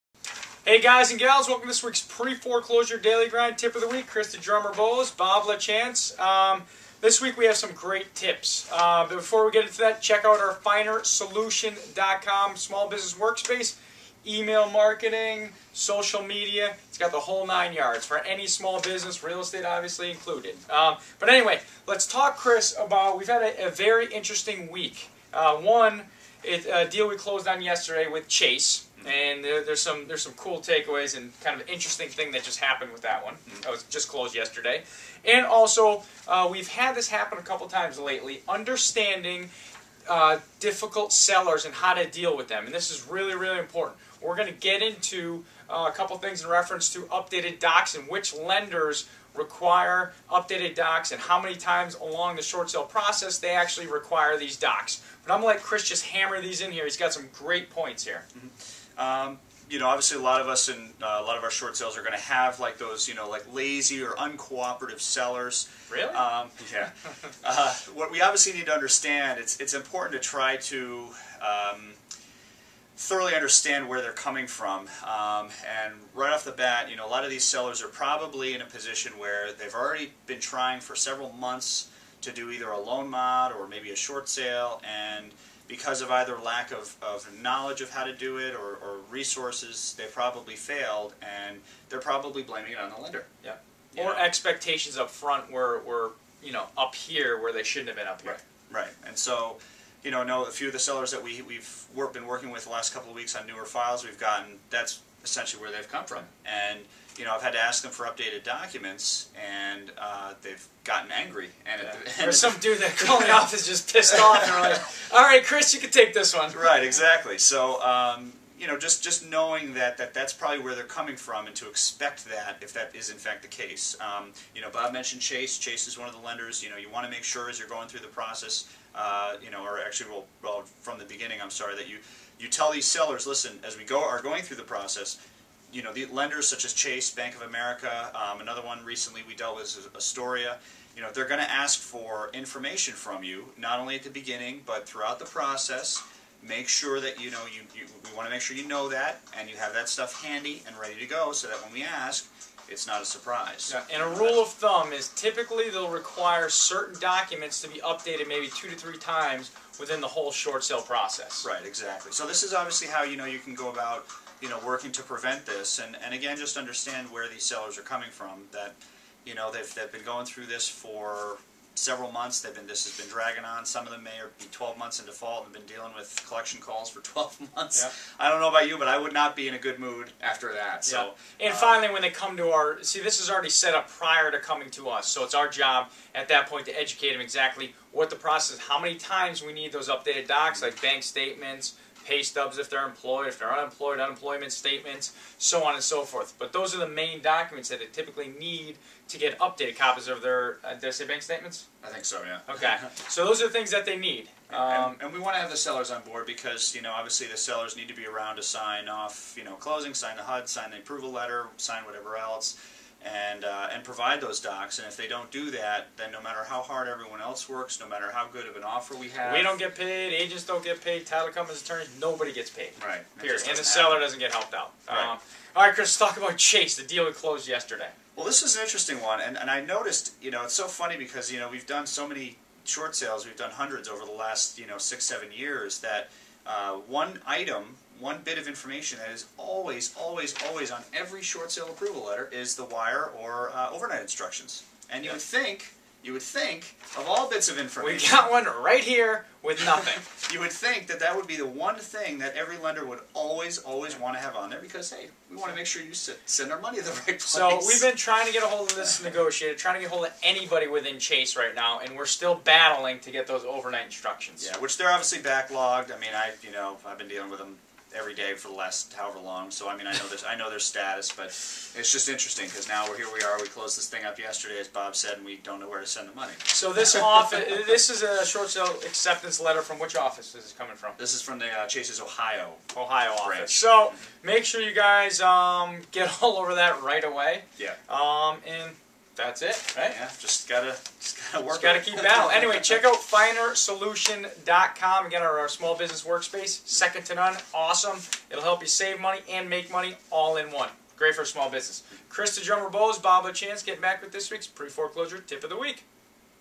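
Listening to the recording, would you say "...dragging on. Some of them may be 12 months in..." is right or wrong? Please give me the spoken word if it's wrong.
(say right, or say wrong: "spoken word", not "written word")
right.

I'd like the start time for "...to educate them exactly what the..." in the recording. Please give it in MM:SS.
03:06.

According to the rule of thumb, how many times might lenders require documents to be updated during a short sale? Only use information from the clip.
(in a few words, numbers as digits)
2 to 3 times.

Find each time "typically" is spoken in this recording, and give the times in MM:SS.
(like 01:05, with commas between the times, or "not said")
02:35, 03:17.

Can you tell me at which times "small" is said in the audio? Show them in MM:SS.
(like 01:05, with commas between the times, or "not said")
00:12, 00:18, 04:55, 05:01.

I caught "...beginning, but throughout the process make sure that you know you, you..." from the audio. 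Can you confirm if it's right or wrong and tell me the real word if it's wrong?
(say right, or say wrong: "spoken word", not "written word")
right.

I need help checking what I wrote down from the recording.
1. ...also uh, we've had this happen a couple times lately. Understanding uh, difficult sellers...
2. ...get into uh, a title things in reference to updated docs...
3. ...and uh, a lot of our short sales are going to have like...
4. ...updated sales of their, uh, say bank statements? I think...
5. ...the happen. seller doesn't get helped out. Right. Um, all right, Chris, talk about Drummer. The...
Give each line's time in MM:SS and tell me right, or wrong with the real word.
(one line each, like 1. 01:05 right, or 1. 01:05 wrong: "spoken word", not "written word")
1. 00:35 right
2. 00:44 wrong: "couple", not "title"
3. 01:00 right
4. 03:19 wrong: "copies", not "sales"
5. 03:43 wrong: "Chase", not "Drummer".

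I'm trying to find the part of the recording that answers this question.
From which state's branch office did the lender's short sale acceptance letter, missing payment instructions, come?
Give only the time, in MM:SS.
04:42.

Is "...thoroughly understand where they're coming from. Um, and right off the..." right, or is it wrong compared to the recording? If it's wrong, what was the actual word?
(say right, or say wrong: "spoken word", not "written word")
right.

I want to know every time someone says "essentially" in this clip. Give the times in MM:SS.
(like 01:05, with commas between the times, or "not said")
01:45.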